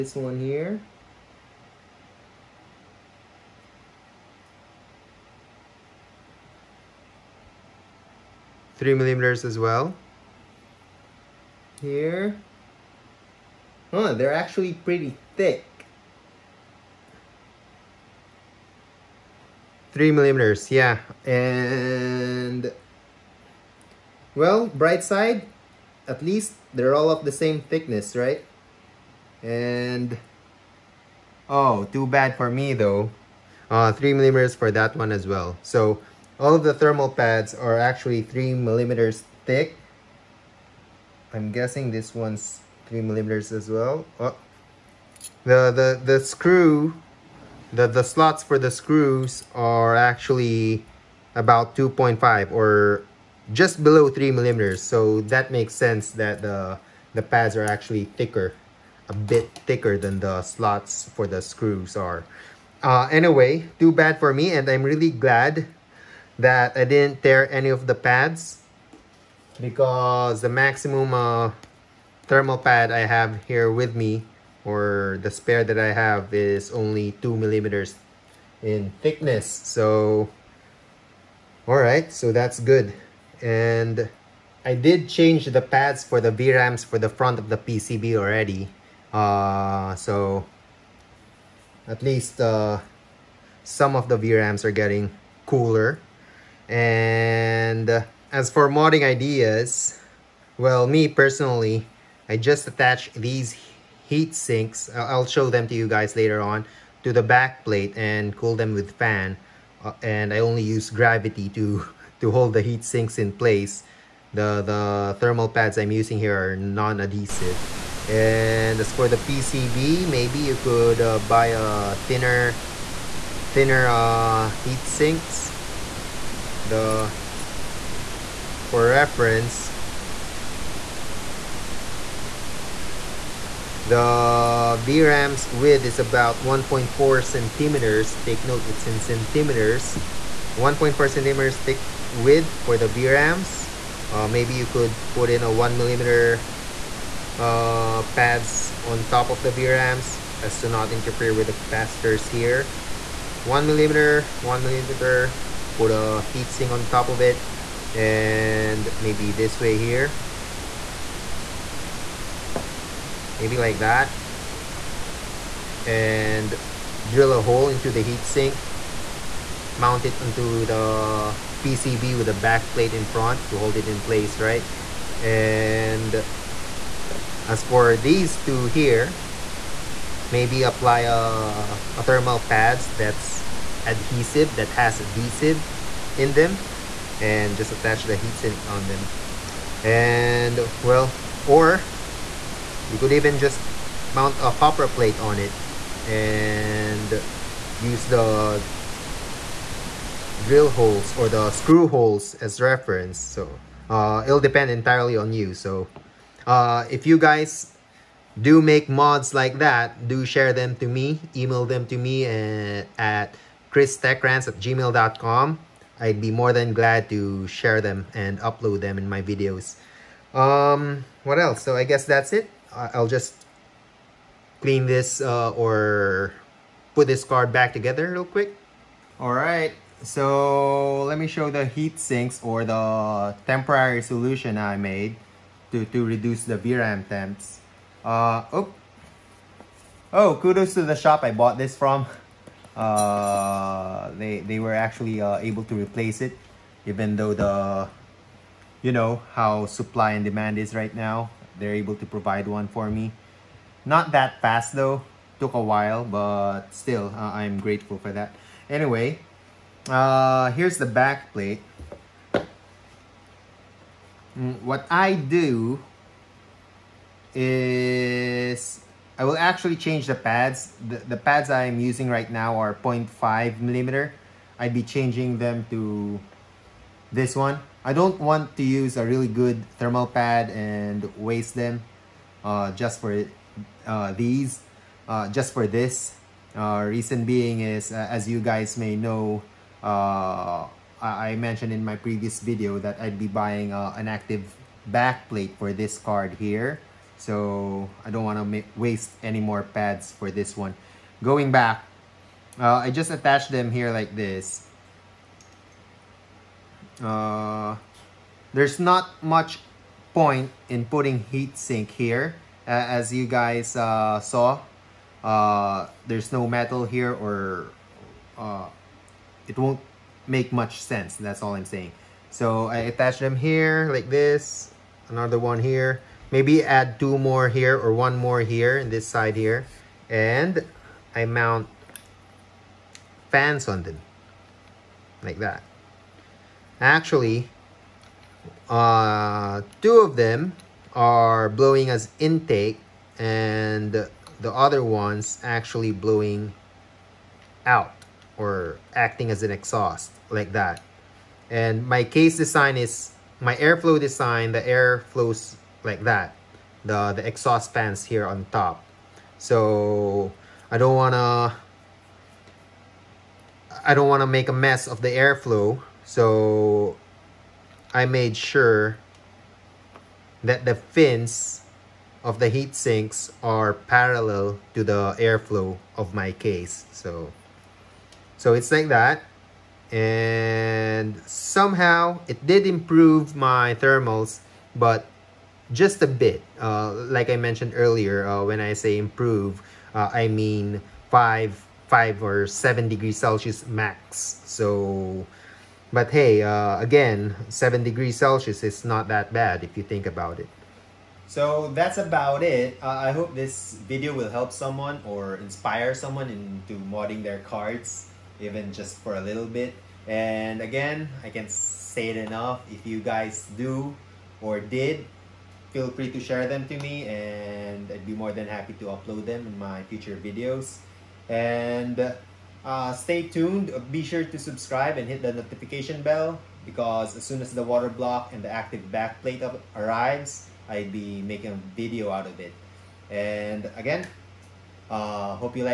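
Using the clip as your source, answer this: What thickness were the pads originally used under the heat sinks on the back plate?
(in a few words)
0.5 millimeter.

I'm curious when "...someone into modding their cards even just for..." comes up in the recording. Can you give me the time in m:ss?
6:45.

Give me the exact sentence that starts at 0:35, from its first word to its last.
So all of the thermal pads are actually 3 millimeters thick.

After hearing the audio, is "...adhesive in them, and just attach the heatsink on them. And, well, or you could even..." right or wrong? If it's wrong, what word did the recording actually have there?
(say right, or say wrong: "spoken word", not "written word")
right.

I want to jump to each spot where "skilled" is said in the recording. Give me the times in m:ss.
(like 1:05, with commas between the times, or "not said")
not said.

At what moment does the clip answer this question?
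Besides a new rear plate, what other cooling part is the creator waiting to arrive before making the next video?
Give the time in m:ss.
7:07.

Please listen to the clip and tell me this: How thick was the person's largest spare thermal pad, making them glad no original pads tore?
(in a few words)
2 millimeters.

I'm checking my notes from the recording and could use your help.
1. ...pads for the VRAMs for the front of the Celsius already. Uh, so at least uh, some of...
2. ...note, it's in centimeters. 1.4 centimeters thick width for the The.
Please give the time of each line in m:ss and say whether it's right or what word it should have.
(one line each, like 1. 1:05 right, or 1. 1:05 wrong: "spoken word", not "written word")
1. 1:25 wrong: "PCB", not "Celsius"
2. 2:18 wrong: "VRAMs", not "The".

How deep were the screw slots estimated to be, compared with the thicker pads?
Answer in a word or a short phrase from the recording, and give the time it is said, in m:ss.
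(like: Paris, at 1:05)
2.5 millimeters, at 0:51.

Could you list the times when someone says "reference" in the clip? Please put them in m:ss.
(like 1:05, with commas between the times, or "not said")
2:08, 3:22.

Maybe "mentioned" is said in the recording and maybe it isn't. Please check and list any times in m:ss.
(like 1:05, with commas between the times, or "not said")
4:51, 6:27.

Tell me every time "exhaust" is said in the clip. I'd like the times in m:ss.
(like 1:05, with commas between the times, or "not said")
5:49, 5:57.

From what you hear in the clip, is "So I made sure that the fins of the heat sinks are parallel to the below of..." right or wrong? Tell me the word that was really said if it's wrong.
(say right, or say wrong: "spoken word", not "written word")
wrong: "airflow", not "below".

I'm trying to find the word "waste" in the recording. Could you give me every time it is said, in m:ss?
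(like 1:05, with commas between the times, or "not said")
4:41, 4:58.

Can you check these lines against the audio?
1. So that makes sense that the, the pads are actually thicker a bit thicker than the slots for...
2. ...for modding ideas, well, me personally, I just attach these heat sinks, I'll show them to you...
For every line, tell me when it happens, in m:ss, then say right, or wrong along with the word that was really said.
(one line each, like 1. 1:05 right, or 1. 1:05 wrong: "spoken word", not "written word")
1. 0:54 right
2. 1:38 right.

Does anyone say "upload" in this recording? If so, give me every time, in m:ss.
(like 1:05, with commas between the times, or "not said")
3:38, 6:58.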